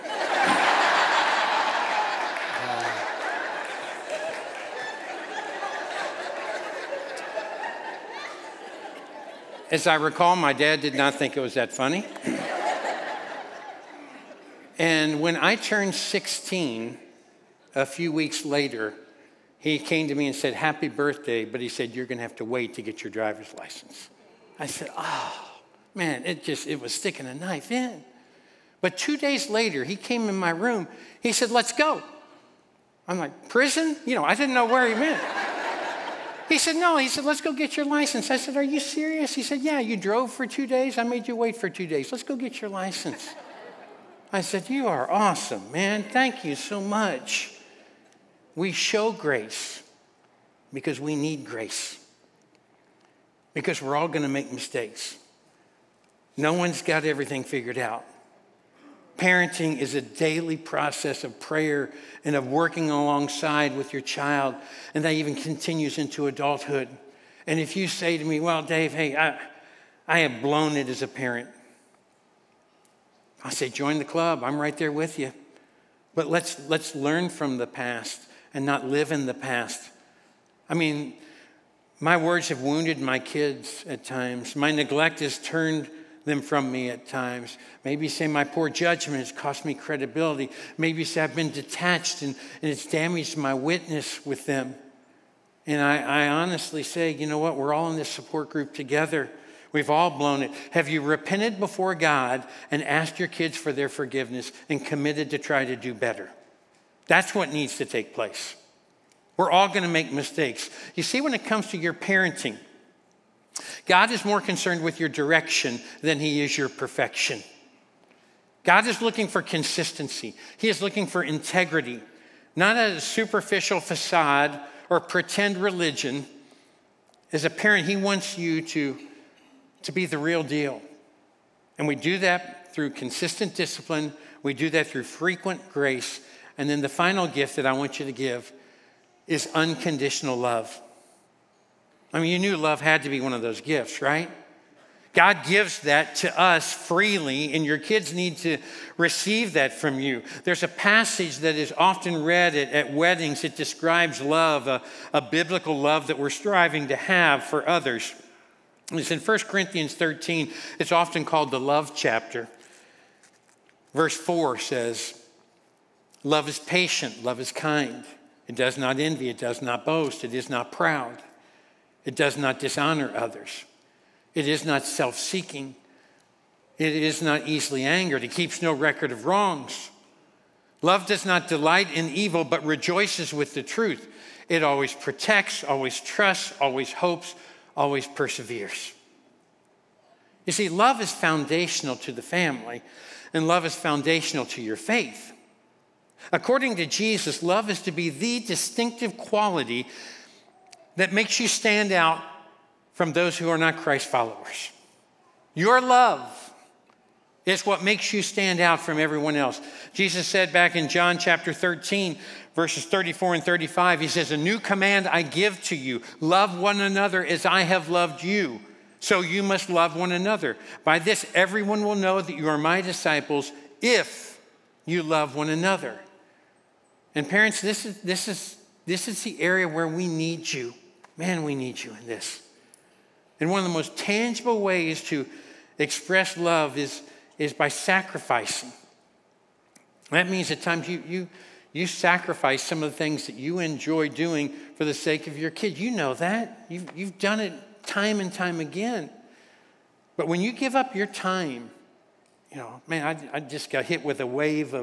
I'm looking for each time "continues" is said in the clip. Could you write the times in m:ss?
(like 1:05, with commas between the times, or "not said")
1:05.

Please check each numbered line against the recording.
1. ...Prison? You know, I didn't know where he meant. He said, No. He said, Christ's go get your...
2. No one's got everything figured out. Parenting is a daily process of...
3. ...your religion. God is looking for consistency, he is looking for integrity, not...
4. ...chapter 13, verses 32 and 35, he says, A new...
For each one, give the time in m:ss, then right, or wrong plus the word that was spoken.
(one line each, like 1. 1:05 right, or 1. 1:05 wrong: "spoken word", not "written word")
1. 0:33 wrong: "Let", not "Christ"
2. 0:56 right
3. 1:56 wrong: "perfection", not "religion"
4. 3:31 wrong: "34", not "32".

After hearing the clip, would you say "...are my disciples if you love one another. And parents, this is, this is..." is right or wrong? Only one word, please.
right.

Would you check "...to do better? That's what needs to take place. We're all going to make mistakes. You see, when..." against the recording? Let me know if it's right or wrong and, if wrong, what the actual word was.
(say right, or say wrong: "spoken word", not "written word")
right.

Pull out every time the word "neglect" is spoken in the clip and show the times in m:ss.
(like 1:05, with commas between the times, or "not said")
1:24.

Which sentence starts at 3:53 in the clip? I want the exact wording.
And one of the most tangible ways to express love is, is by sacrificing.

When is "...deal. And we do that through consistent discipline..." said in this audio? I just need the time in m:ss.
2:10.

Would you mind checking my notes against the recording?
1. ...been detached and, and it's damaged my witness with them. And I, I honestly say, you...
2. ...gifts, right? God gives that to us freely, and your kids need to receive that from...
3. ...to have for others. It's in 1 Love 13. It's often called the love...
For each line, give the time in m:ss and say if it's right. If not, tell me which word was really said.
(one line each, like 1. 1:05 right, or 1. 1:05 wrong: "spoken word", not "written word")
1. 1:31 right
2. 2:23 right
3. 2:36 wrong: "Corinthians", not "Love".